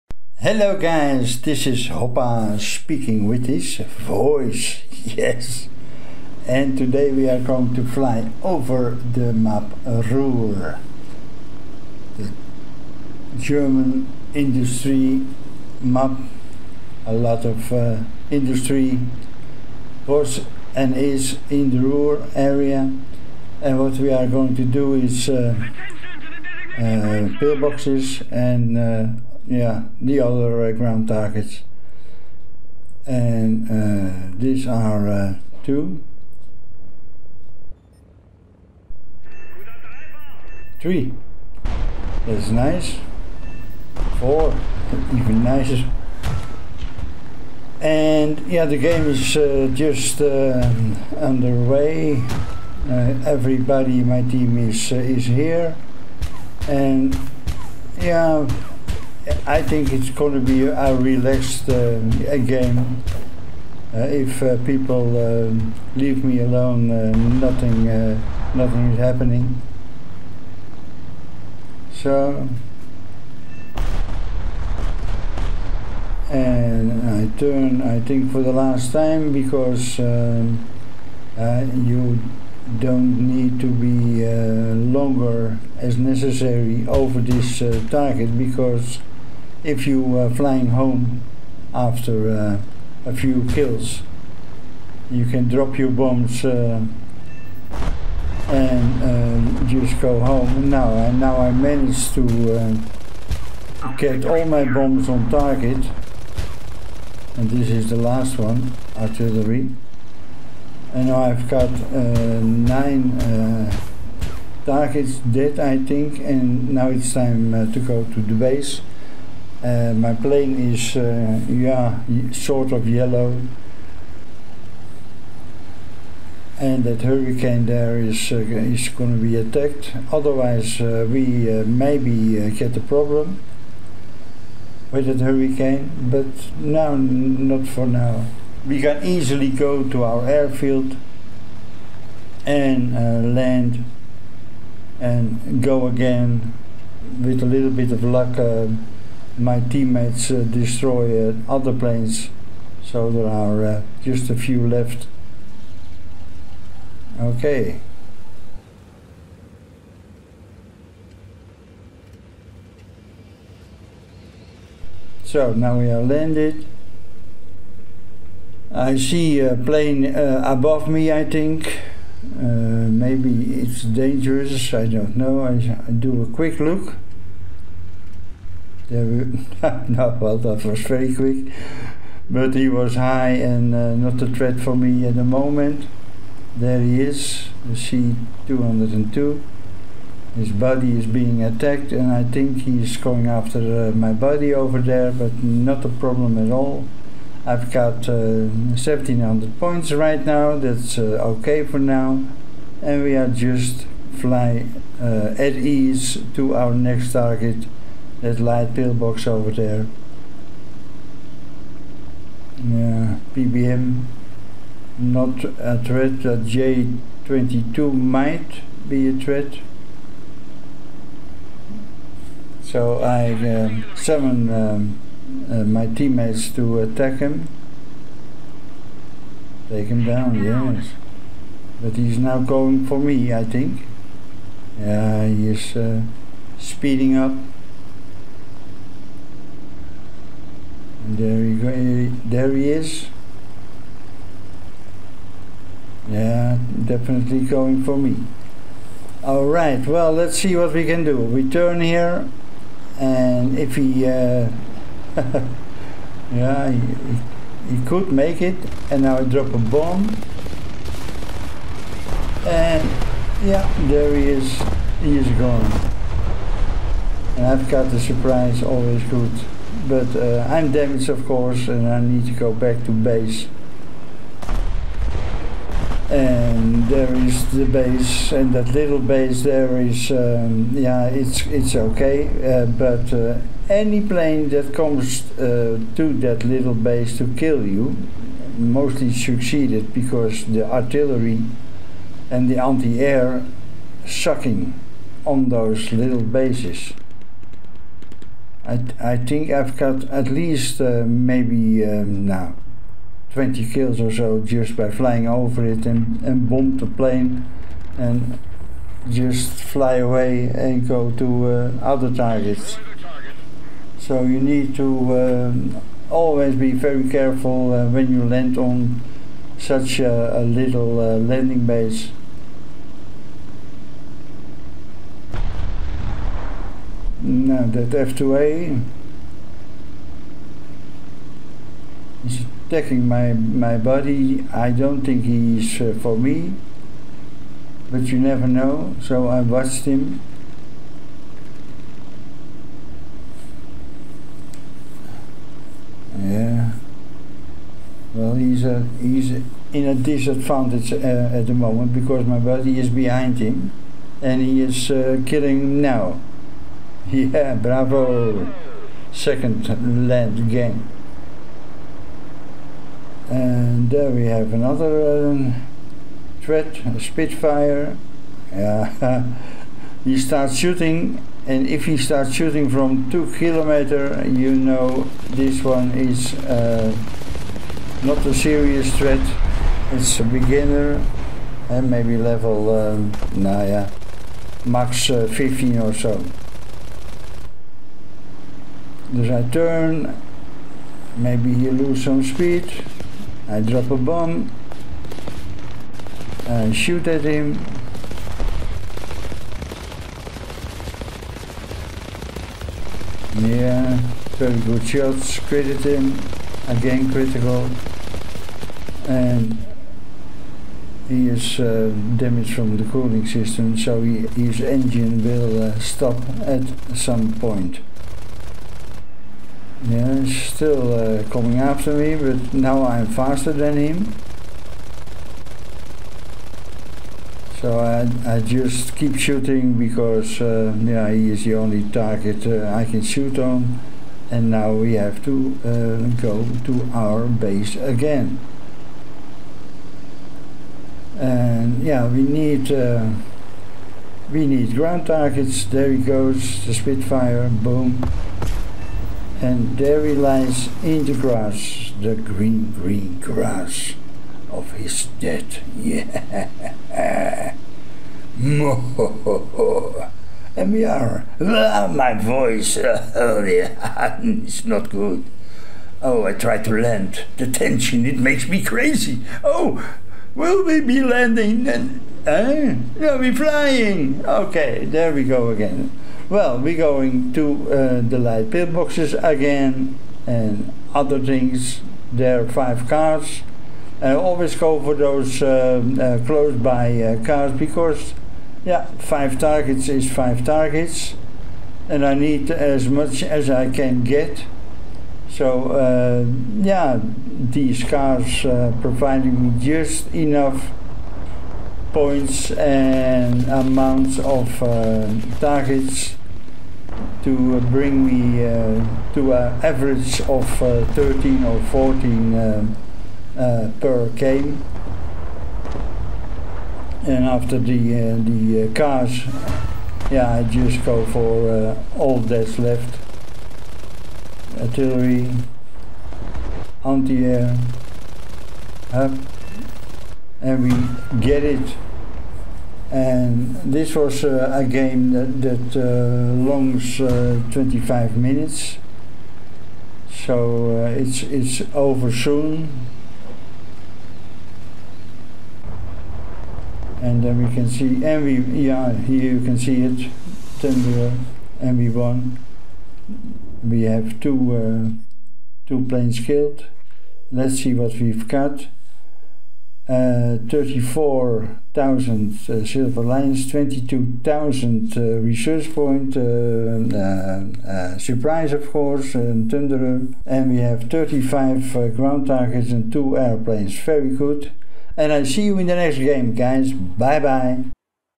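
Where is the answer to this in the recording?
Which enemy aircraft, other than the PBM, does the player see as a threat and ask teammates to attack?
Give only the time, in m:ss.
3:36.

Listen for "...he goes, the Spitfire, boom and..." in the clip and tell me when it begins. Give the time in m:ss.
7:25.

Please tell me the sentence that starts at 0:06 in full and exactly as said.
And today we are going to fly over the map Ruhr, the German industry map.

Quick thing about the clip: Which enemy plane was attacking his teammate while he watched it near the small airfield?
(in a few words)
F2A.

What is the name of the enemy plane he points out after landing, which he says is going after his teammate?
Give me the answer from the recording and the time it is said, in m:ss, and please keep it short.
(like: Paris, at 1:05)
C202, at 3:07.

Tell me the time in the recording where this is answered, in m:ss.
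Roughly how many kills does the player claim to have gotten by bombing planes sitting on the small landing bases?
5:03.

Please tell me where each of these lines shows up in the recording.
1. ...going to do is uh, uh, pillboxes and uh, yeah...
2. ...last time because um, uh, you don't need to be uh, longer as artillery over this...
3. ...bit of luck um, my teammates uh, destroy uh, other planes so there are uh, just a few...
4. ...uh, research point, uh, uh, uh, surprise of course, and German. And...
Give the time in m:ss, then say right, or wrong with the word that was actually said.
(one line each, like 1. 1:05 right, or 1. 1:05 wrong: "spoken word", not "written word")
1. 0:24 right
2. 1:18 wrong: "necessary", not "artillery"
3. 2:27 right
4. 9:24 wrong: "Thunderer", not "German".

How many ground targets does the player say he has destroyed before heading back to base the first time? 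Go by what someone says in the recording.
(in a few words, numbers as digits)
9.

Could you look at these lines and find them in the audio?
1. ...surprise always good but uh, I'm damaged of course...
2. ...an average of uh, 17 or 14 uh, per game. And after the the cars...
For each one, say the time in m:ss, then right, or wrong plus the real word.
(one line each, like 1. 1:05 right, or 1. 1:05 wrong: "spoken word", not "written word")
1. 4:27 right
2. 8:29 wrong: "13", not "17".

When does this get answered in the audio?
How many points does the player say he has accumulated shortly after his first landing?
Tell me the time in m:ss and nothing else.
3:18.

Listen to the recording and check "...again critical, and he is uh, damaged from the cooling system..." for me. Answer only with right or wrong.
right.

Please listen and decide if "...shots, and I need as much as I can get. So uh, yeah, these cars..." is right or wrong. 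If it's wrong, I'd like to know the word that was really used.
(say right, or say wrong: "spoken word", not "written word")
wrong: "targets", not "shots".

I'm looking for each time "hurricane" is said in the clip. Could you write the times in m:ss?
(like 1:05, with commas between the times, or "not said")
2:07, 2:15.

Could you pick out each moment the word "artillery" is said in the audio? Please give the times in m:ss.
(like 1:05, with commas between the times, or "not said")
1:48, 4:50, 8:44.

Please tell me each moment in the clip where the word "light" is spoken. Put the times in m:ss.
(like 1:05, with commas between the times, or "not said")
3:28, 7:58.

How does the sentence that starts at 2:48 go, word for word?
I see a plane uh, above me, I think.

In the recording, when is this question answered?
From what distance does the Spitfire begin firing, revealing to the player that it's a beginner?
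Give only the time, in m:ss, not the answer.
6:13.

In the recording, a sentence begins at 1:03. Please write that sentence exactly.
Uh, if uh, people um, leave me alone, uh, nothing, uh, nothing is happening.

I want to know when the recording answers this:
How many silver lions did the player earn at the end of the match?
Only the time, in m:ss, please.
9:20.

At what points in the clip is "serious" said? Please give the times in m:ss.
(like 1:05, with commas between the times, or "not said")
6:18.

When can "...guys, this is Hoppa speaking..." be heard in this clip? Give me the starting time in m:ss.
0:00.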